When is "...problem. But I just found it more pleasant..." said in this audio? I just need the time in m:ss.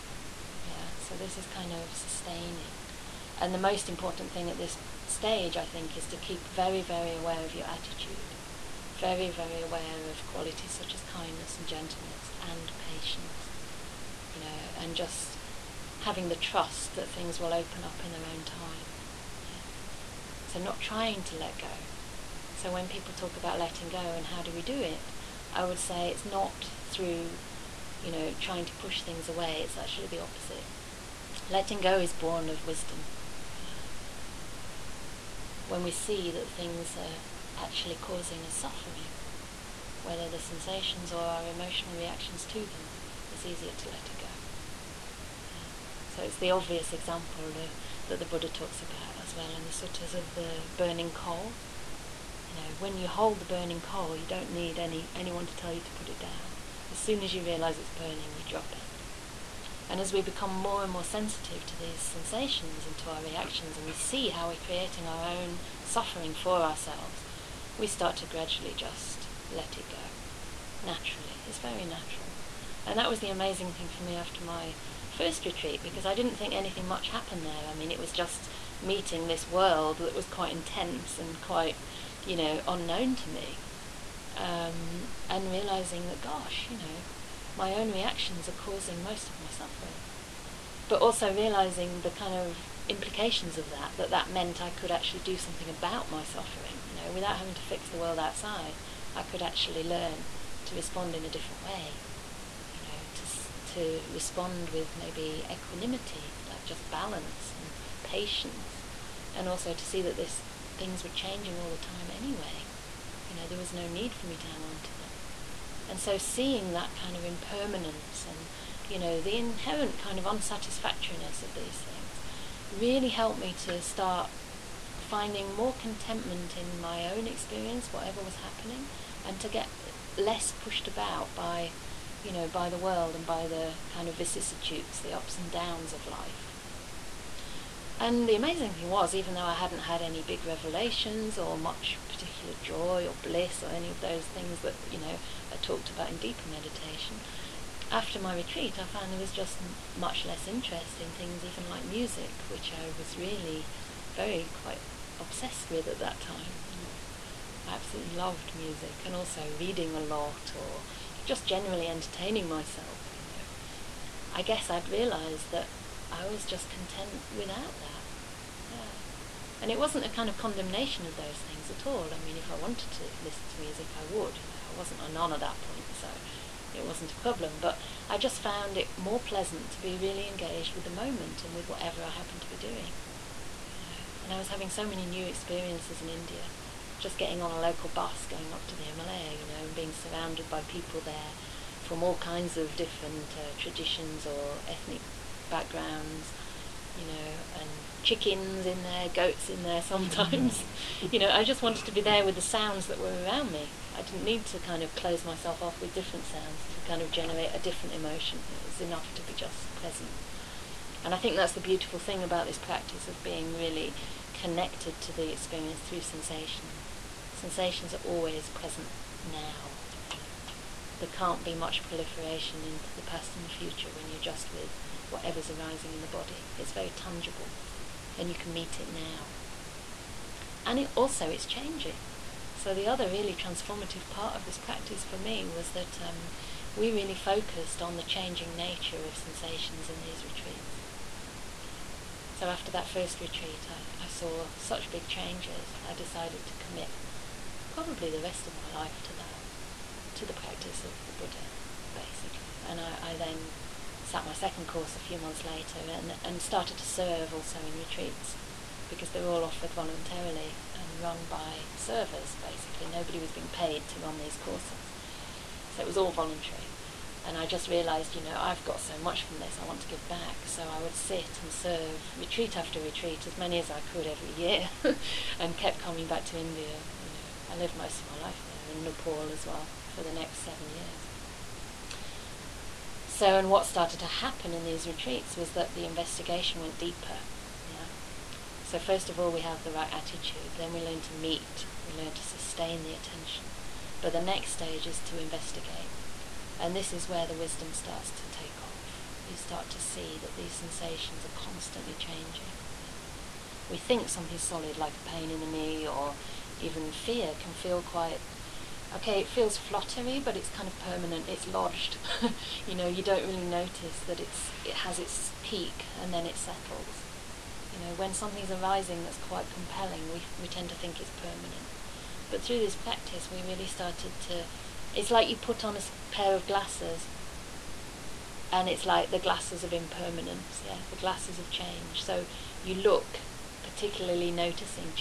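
2:57.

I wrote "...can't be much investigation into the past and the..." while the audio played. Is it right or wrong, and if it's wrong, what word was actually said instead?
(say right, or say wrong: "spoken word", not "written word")
wrong: "proliferation", not "investigation".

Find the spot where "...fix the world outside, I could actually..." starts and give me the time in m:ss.
1:37.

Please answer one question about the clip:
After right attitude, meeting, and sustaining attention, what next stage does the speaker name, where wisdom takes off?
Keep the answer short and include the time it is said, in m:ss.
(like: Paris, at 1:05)
investigate, at 4:55.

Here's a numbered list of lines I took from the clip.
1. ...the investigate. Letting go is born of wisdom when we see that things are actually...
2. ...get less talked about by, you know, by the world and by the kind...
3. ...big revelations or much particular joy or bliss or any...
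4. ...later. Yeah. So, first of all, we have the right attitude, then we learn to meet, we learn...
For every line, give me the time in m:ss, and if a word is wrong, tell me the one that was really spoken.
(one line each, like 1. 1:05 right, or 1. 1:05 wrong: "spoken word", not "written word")
1. 0:30 wrong: "opposite", not "investigate"
2. 2:09 wrong: "pushed", not "talked"
3. 2:20 right
4. 4:46 wrong: "deeper", not "later".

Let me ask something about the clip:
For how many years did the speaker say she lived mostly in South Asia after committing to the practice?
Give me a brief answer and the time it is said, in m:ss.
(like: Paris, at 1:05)
7, at 4:40.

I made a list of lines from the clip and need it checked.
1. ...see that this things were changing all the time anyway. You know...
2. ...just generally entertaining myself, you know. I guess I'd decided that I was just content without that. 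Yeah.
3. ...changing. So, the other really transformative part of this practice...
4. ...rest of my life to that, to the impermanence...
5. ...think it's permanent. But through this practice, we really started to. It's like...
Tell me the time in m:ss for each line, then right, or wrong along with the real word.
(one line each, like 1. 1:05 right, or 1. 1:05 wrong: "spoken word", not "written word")
1. 1:49 right
2. 2:41 wrong: "realised", not "decided"
3. 3:51 right
4. 4:08 wrong: "practice", not "impermanence"
5. 5:20 right.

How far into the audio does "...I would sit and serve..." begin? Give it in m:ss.
4:30.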